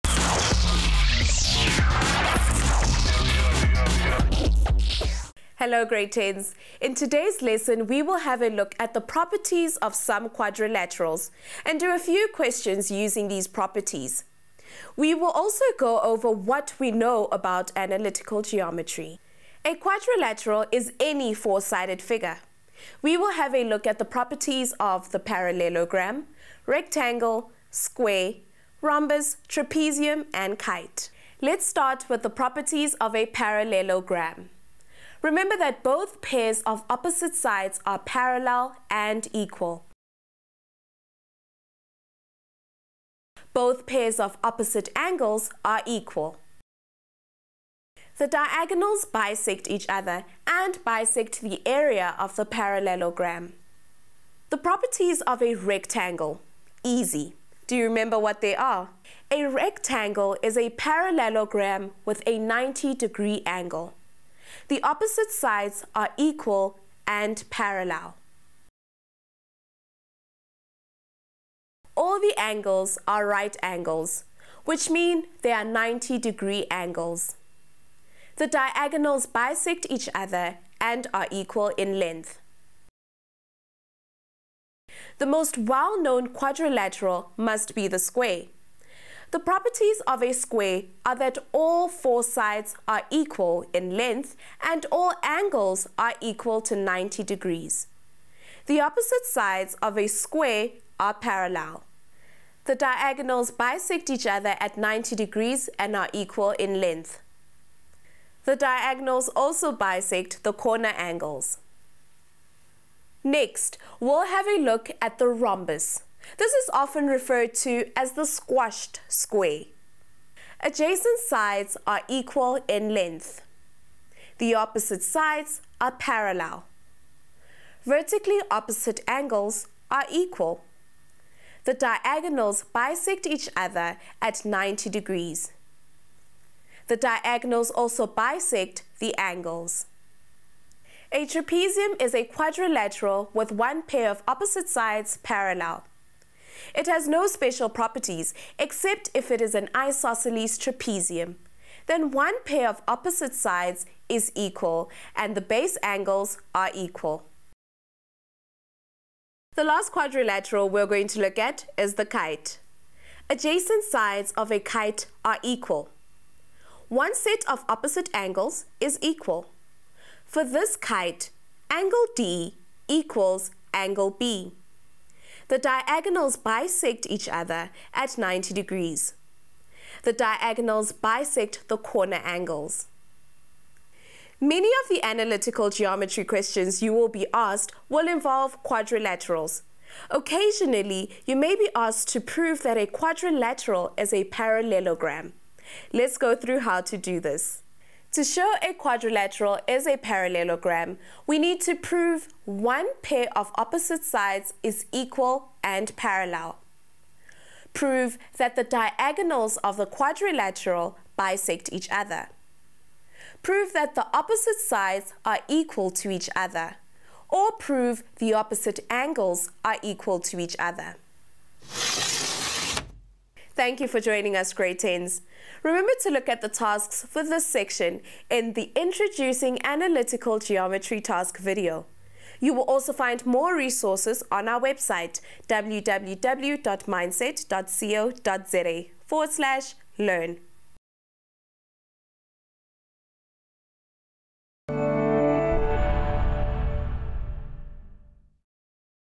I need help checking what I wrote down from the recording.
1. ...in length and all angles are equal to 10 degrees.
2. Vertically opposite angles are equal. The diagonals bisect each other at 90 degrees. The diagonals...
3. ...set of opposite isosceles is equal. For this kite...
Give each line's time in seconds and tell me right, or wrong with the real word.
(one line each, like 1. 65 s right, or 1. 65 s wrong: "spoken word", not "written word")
1. 93 s wrong: "90", not "10"
2. 127 s right
3. 167 s wrong: "angles", not "isosceles".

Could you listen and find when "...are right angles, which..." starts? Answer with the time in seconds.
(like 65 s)
73 s.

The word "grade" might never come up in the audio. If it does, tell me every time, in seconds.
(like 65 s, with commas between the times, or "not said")
5 s, 224 s.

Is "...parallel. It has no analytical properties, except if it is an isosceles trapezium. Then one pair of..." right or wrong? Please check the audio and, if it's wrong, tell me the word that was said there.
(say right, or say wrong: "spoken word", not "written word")
wrong: "special", not "analytical".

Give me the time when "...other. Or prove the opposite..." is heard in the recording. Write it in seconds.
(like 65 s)
216 s.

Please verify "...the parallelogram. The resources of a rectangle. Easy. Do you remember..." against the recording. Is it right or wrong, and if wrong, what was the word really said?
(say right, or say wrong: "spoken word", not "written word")
wrong: "properties", not "resources".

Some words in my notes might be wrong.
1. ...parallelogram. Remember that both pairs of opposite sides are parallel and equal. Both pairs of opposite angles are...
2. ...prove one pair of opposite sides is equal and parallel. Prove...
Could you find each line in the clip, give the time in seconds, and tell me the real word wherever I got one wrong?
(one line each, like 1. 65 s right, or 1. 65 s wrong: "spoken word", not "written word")
1. 33 s right
2. 201 s right.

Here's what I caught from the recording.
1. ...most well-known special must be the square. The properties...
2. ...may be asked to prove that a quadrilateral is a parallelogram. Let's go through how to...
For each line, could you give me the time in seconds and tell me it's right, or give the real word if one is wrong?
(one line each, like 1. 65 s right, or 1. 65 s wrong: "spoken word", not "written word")
1. 85 s wrong: "quadrilateral", not "special"
2. 191 s right.